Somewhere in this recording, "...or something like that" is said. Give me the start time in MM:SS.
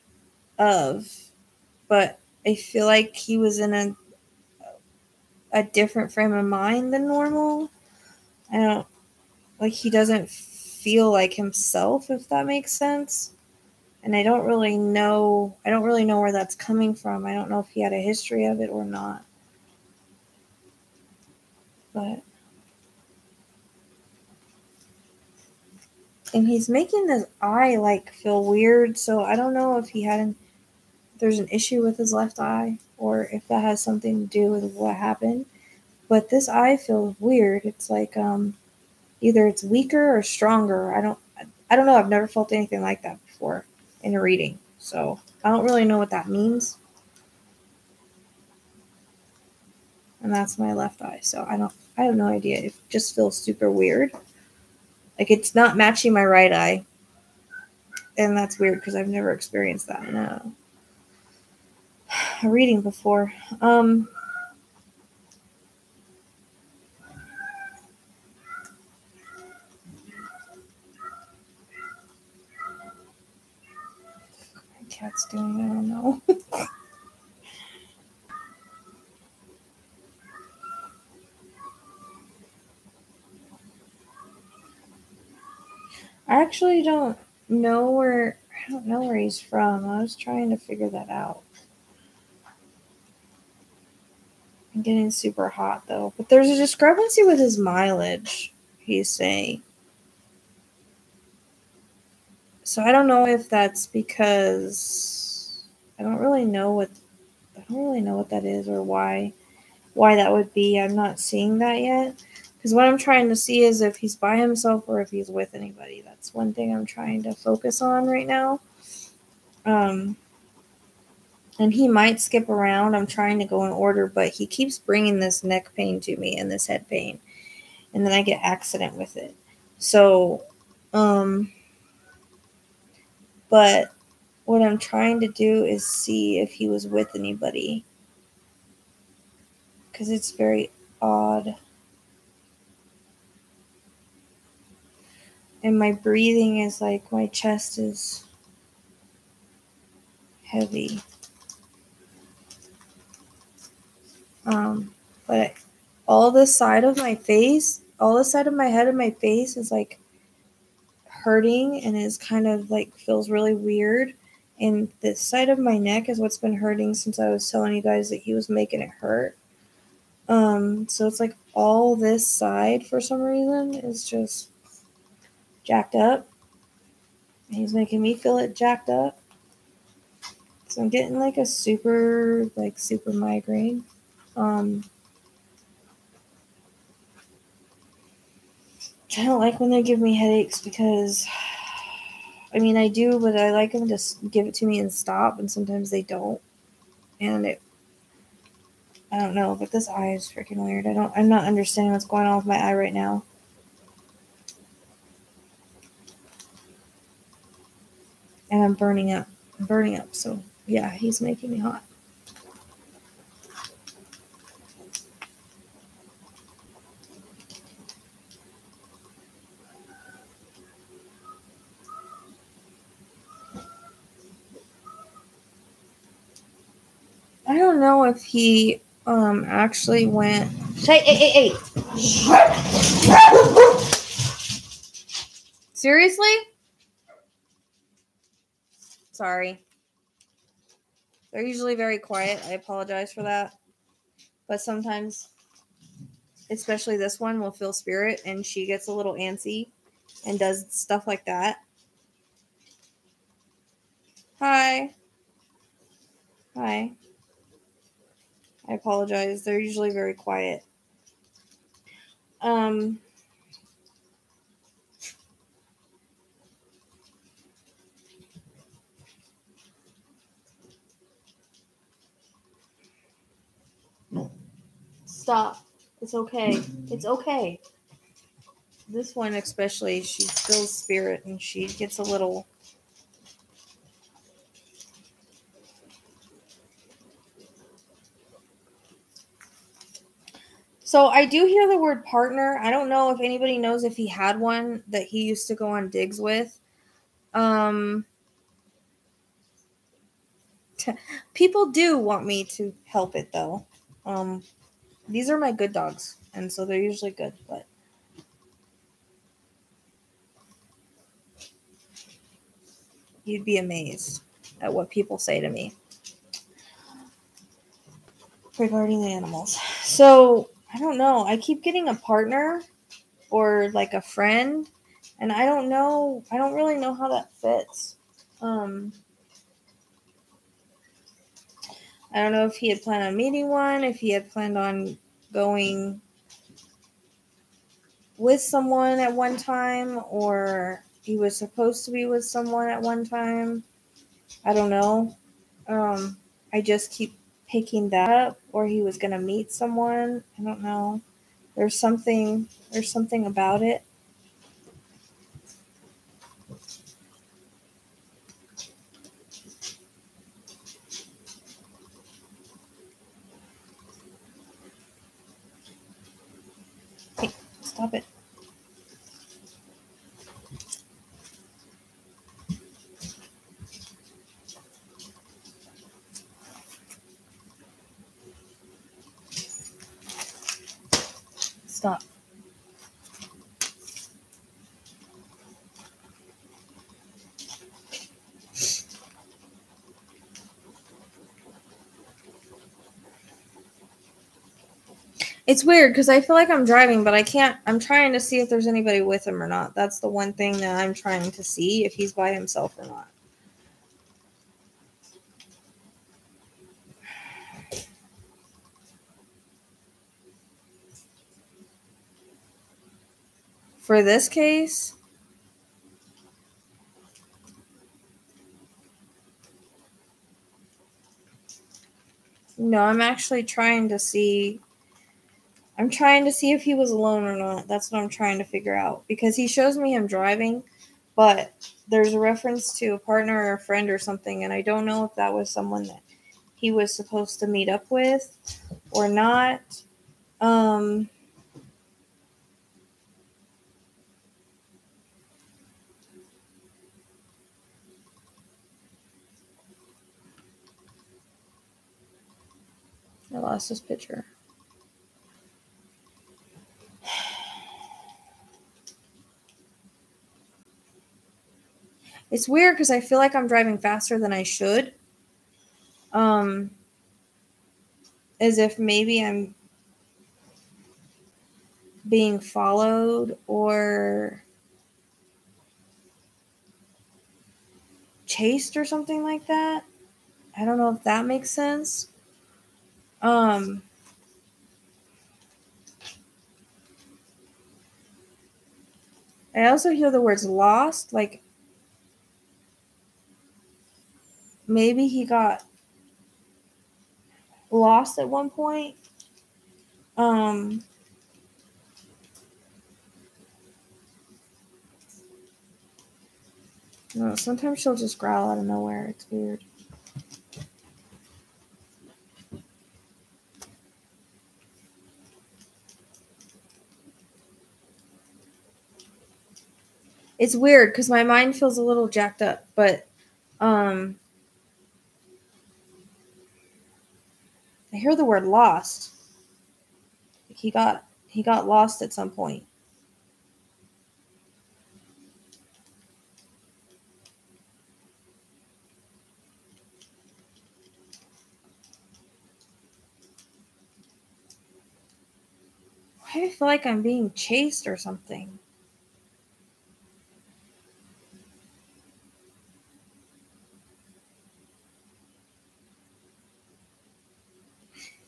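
07:58.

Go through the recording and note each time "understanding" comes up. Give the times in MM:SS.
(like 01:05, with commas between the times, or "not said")
03:21.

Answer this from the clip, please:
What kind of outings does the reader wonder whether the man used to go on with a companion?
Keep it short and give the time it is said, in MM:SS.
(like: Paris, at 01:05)
digs, at 04:55.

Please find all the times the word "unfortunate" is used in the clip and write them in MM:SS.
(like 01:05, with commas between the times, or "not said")
not said.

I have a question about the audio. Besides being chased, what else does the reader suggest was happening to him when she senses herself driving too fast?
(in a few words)
being followed.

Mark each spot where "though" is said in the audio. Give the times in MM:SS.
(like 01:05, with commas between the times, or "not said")
01:35, 05:03.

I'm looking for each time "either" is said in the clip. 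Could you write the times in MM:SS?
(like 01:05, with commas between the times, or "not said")
00:39.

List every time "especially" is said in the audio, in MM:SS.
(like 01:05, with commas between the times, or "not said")
04:06, 04:39.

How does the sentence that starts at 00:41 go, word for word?
I've never felt anything like that before in a reading.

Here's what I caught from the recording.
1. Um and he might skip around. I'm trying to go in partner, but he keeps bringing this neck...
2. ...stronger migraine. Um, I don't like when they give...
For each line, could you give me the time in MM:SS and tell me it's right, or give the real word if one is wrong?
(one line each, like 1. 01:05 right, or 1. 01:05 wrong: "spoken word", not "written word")
1. 01:59 wrong: "order", not "partner"
2. 03:02 wrong: "super", not "stronger".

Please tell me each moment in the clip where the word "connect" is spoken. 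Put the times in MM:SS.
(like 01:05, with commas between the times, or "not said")
not said.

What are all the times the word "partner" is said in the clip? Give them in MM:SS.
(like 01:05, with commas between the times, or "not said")
04:52, 05:21, 07:12.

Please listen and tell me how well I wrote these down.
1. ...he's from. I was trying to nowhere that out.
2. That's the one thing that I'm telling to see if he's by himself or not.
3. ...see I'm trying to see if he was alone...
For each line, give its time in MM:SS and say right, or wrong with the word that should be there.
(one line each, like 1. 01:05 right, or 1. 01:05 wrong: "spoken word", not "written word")
1. 01:29 wrong: "figure", not "nowhere"
2. 06:39 wrong: "trying", not "telling"
3. 07:03 right.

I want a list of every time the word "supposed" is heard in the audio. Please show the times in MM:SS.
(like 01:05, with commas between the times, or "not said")
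05:41, 07:16.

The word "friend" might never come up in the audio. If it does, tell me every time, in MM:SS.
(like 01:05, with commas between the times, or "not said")
05:24, 07:13.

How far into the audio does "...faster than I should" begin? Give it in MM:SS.
07:43.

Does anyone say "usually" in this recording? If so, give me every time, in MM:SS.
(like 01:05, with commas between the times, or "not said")
04:01, 04:19, 05:06.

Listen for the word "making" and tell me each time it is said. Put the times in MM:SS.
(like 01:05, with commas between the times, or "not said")
00:26, 02:48, 02:57, 03:31.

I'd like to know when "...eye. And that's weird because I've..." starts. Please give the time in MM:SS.
00:56.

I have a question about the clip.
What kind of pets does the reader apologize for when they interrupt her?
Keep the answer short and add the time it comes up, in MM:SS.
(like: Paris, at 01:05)
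dogs, at 05:05.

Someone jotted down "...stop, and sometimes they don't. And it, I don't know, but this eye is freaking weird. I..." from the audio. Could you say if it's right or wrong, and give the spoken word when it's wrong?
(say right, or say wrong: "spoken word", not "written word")
right.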